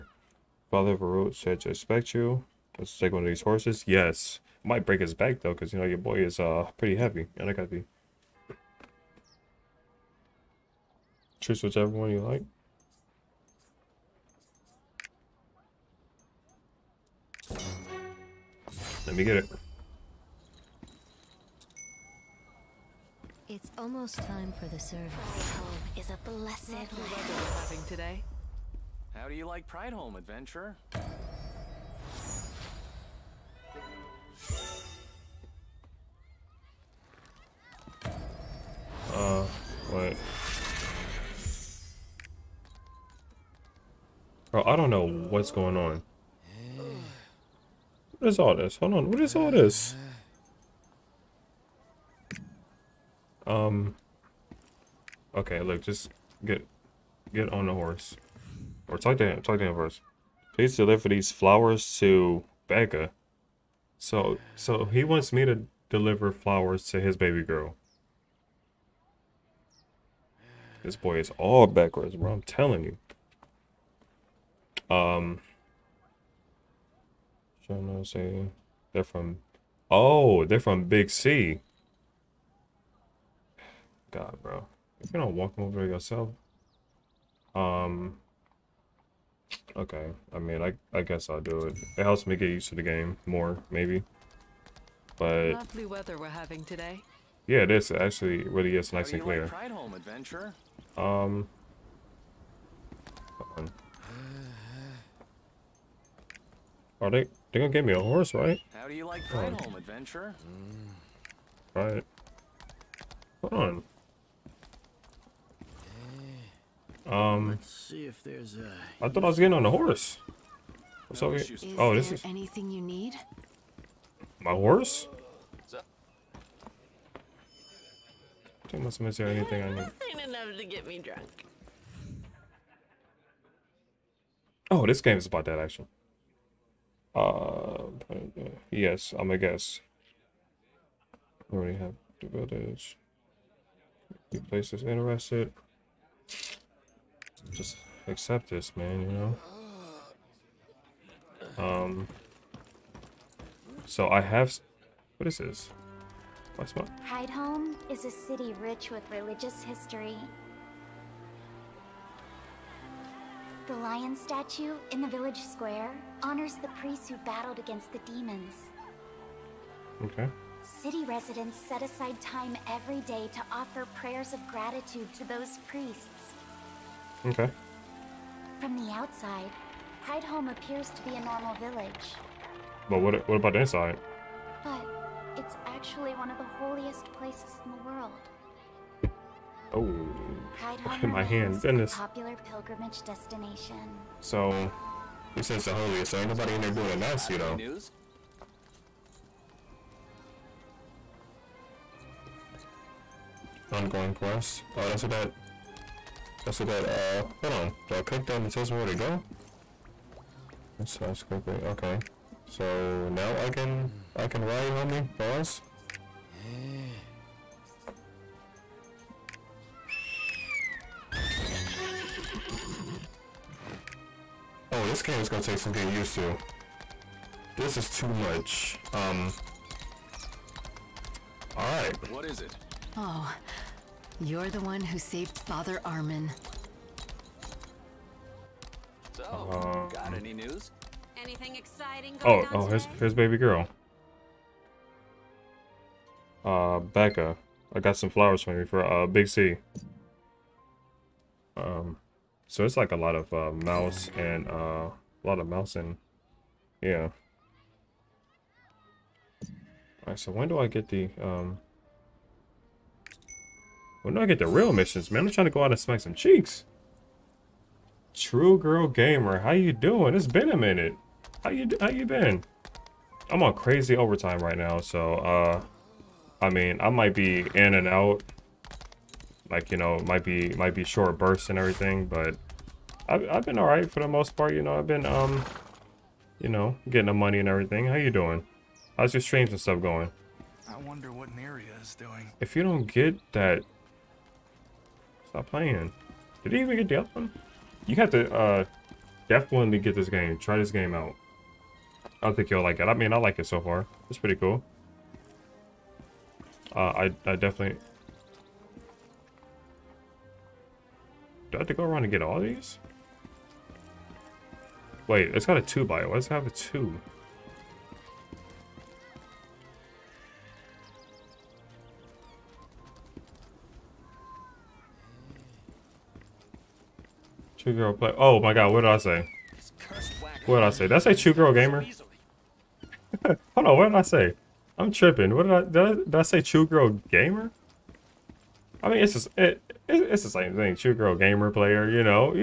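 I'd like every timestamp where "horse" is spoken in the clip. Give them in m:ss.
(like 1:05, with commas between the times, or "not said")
0:03, 0:57, 1:48, 1:59, 2:04.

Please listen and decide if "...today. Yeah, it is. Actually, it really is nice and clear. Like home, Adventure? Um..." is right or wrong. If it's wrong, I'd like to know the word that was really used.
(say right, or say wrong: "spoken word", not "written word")
right.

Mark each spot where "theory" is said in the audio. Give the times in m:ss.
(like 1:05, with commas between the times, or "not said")
not said.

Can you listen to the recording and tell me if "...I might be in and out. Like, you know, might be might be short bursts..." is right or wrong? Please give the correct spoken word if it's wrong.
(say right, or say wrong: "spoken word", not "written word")
right.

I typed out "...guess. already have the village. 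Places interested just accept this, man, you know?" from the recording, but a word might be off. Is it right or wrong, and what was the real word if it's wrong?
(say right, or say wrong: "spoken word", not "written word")
right.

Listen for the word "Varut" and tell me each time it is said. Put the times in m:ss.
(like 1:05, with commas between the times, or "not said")
0:00.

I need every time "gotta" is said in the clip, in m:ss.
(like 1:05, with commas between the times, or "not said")
0:07.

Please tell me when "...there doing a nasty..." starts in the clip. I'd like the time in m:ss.
3:16.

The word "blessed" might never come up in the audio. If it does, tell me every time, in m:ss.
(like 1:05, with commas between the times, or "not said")
0:26.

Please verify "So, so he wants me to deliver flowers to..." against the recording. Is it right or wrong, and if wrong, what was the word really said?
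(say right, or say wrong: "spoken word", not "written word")
right.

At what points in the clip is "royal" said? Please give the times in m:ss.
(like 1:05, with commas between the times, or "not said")
not said.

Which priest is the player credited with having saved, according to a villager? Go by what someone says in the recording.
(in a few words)
Father Armin.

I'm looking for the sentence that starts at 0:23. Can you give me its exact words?
It's almost time for the service.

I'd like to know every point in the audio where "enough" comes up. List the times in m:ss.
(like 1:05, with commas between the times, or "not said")
2:10.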